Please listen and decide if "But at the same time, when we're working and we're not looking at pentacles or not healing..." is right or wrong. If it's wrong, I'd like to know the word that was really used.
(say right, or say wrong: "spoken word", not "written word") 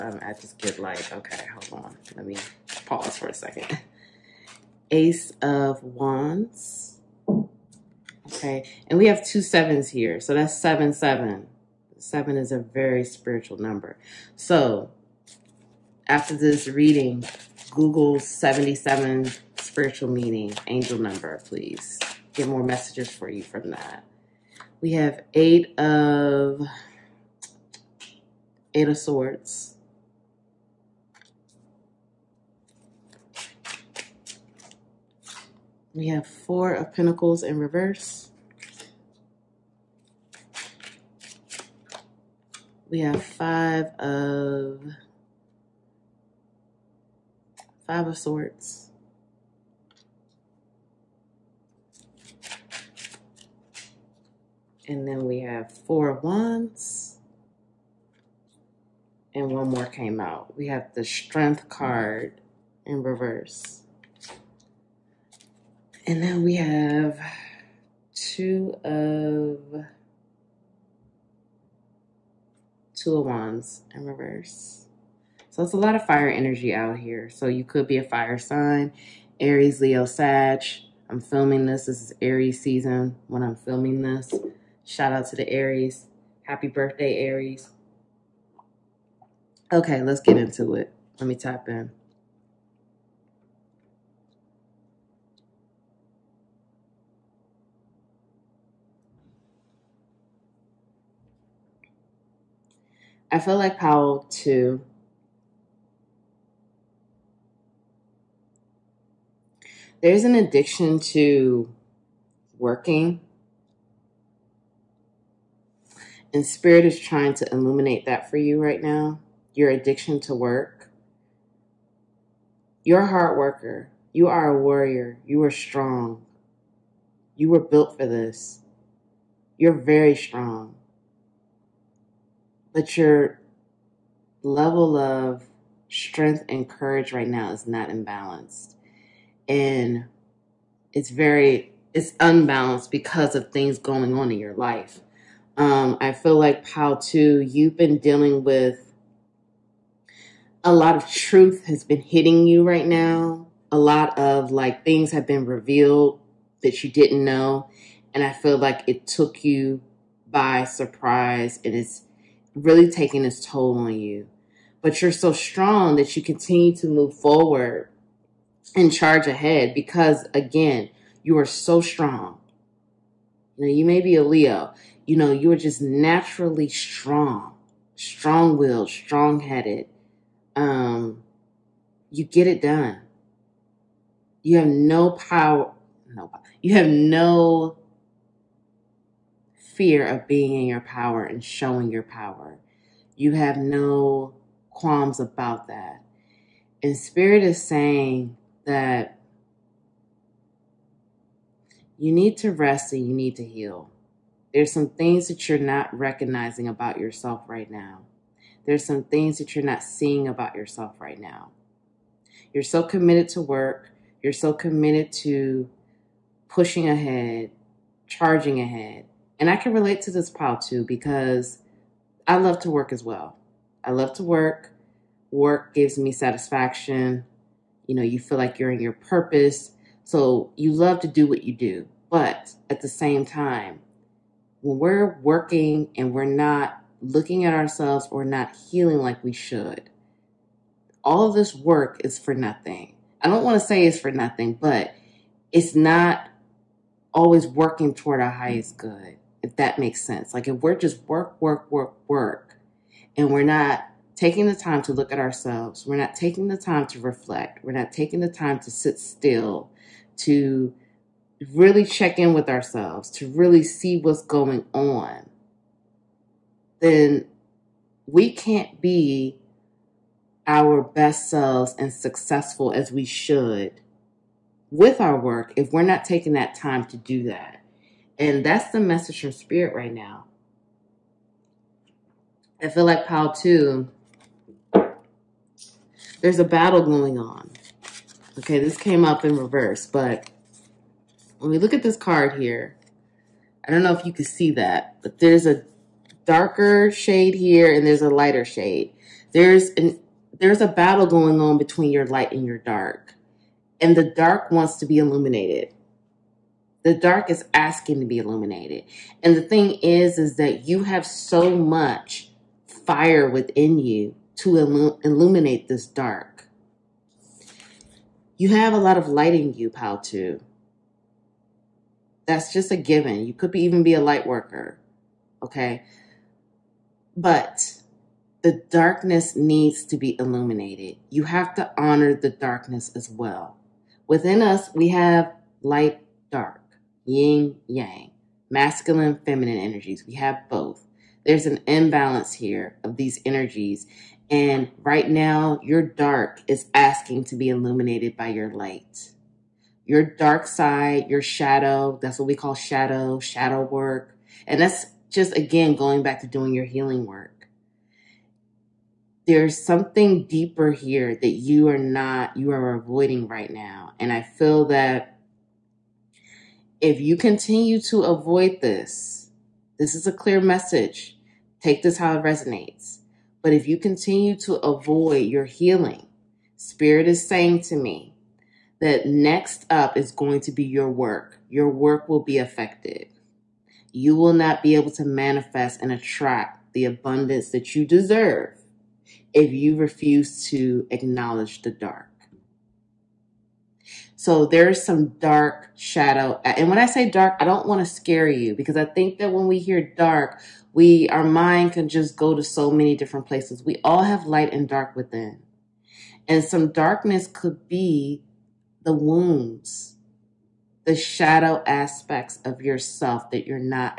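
wrong: "ourselves", not "pentacles".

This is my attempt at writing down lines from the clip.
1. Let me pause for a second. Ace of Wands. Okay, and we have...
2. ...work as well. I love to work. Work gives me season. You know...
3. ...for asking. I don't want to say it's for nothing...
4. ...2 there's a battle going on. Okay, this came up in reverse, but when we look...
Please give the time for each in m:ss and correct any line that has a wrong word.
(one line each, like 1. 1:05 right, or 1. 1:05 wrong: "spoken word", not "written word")
1. 0:02 right
2. 3:42 wrong: "satisfaction", not "season"
3. 4:02 wrong: "nothing", not "asking"
4. 4:43 right.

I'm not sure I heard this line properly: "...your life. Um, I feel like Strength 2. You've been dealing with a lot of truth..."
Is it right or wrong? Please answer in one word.
wrong.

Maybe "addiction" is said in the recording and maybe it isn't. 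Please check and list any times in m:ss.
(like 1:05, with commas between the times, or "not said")
1:50, 1:59.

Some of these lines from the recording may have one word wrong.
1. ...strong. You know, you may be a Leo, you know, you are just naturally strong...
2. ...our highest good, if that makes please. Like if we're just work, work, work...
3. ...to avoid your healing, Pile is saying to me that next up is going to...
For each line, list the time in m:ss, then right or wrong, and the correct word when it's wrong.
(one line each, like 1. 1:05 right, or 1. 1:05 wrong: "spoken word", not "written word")
1. 2:51 right
2. 4:08 wrong: "sense", not "please"
3. 6:14 wrong: "Spirit", not "Pile".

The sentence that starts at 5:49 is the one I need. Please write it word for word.
Your dark side, your shadow, that's what we call shadow, shadow work.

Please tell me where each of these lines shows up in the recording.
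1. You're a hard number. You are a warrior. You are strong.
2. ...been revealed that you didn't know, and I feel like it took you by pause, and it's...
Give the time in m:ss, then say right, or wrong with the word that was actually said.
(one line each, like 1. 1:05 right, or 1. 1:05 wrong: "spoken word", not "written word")
1. 2:02 wrong: "worker", not "number"
2. 2:35 wrong: "surprise", not "pause".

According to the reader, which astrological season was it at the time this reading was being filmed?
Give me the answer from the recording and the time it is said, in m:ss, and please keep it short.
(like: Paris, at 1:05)
Aries season, at 1:22.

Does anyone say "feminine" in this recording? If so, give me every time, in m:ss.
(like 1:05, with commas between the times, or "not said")
5:39.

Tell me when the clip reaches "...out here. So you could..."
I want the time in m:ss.
1:16.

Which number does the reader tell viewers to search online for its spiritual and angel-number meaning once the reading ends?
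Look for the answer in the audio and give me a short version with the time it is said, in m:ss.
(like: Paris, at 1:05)
77, at 0:18.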